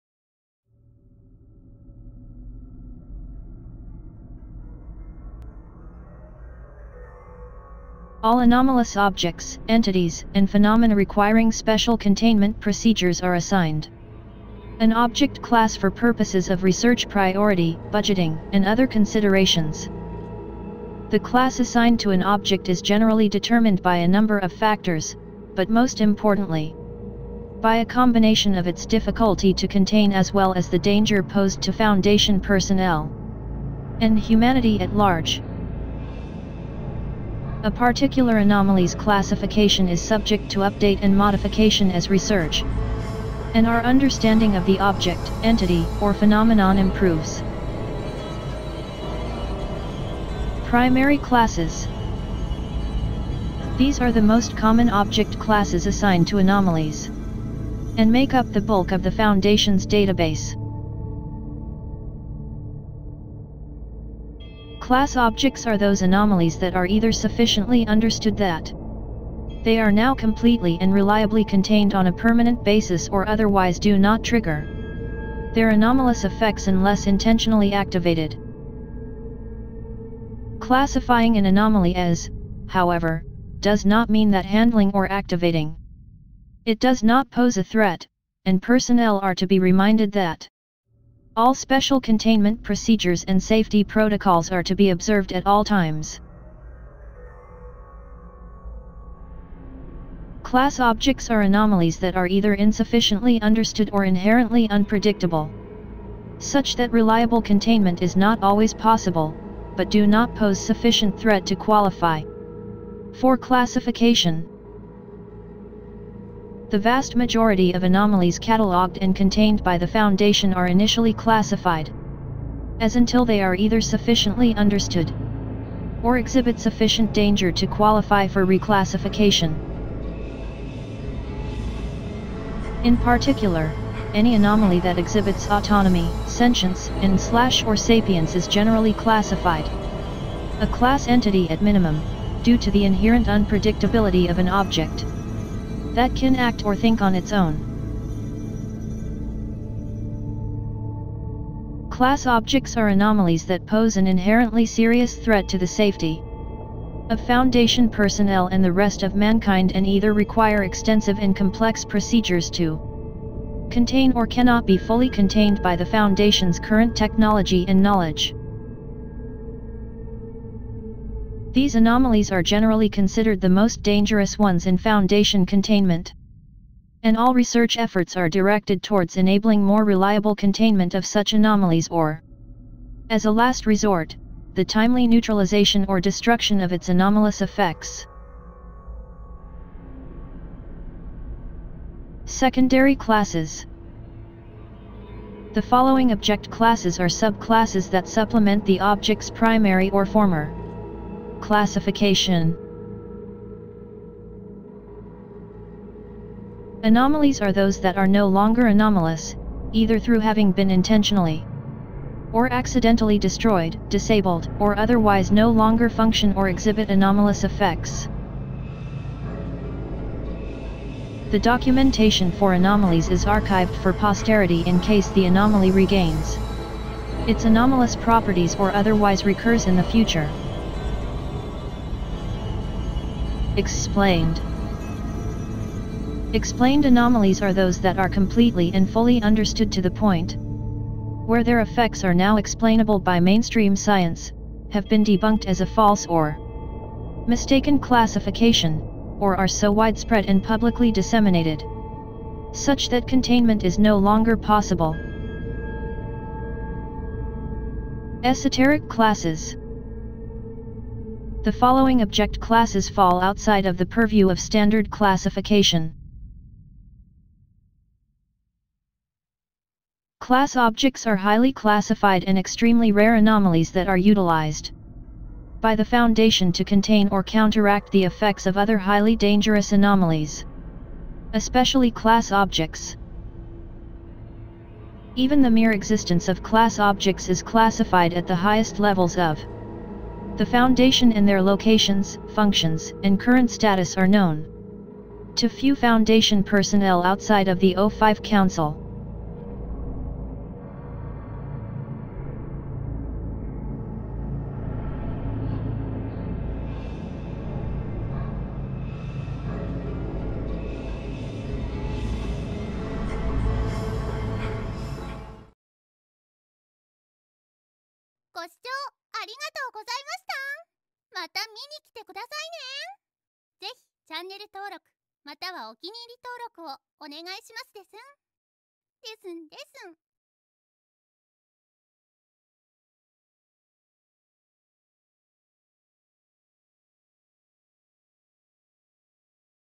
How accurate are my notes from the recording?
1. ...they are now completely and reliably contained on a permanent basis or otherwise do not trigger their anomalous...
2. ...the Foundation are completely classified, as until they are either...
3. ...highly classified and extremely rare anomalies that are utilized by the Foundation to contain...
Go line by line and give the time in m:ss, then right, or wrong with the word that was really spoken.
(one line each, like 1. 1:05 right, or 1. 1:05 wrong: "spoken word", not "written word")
1. 1:09 right
2. 1:59 wrong: "initially", not "completely"
3. 4:31 right.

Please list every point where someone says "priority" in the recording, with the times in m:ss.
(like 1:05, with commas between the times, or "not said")
0:17.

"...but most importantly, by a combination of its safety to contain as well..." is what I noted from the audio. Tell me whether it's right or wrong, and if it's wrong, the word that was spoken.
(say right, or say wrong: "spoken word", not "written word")
wrong: "difficulty", not "safety".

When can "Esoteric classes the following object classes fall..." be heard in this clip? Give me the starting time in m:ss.
4:18.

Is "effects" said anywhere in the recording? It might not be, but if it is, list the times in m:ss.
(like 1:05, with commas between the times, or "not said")
1:16, 3:07, 3:37, 4:01, 4:38.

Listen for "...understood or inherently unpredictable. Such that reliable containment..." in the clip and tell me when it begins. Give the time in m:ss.
1:43.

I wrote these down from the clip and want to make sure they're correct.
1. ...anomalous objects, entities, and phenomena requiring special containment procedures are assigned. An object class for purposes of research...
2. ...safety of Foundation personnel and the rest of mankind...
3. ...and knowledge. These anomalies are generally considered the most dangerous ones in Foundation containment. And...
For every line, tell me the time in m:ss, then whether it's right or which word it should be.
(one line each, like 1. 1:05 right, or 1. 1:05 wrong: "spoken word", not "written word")
1. 0:08 right
2. 2:35 right
3. 2:47 right.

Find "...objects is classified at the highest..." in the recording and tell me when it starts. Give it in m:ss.
4:46.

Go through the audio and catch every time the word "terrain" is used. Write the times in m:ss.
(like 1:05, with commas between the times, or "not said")
not said.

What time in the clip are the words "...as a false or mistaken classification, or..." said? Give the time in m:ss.
4:05.